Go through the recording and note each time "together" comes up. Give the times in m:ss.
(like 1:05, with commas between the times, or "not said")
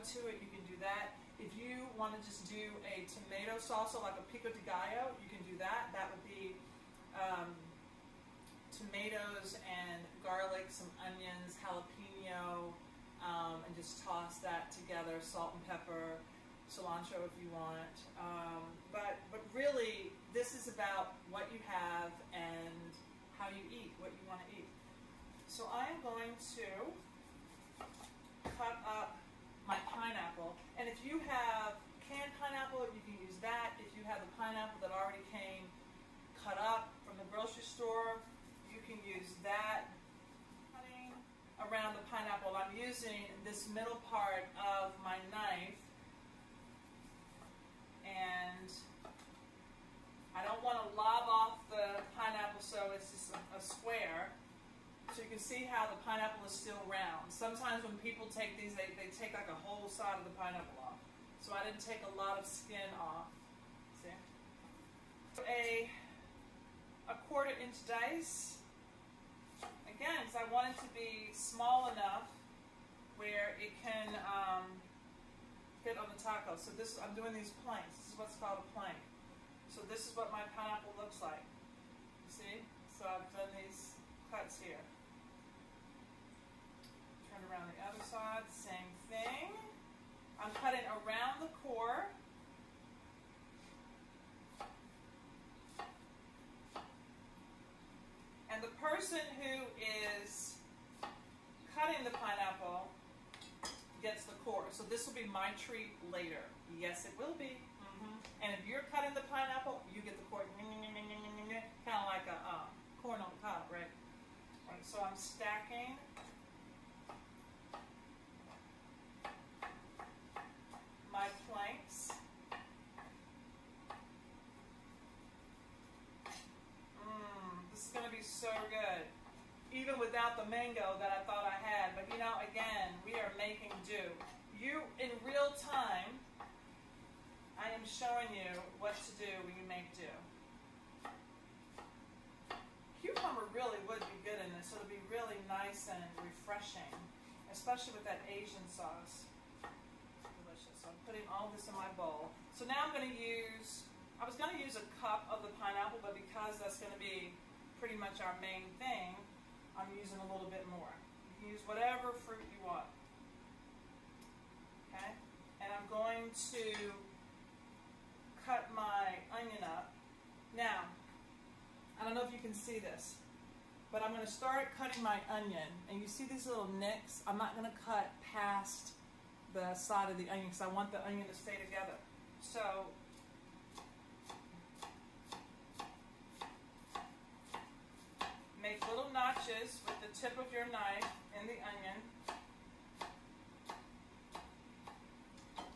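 0:14, 3:01.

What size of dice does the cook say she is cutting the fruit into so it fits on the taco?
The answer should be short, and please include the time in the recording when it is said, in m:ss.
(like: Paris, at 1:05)
quarter inch, at 1:07.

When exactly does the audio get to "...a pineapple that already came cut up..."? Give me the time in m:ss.
0:34.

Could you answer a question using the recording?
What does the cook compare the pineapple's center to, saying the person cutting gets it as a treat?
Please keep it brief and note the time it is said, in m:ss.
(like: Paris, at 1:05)
corn on the cob, at 1:53.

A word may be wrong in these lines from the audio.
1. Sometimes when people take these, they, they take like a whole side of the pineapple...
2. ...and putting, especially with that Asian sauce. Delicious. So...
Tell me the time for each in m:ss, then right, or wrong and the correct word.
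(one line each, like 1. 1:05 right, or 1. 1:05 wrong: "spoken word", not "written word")
1. 0:57 right
2. 2:25 wrong: "refreshing", not "putting".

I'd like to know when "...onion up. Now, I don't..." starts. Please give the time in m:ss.
2:49.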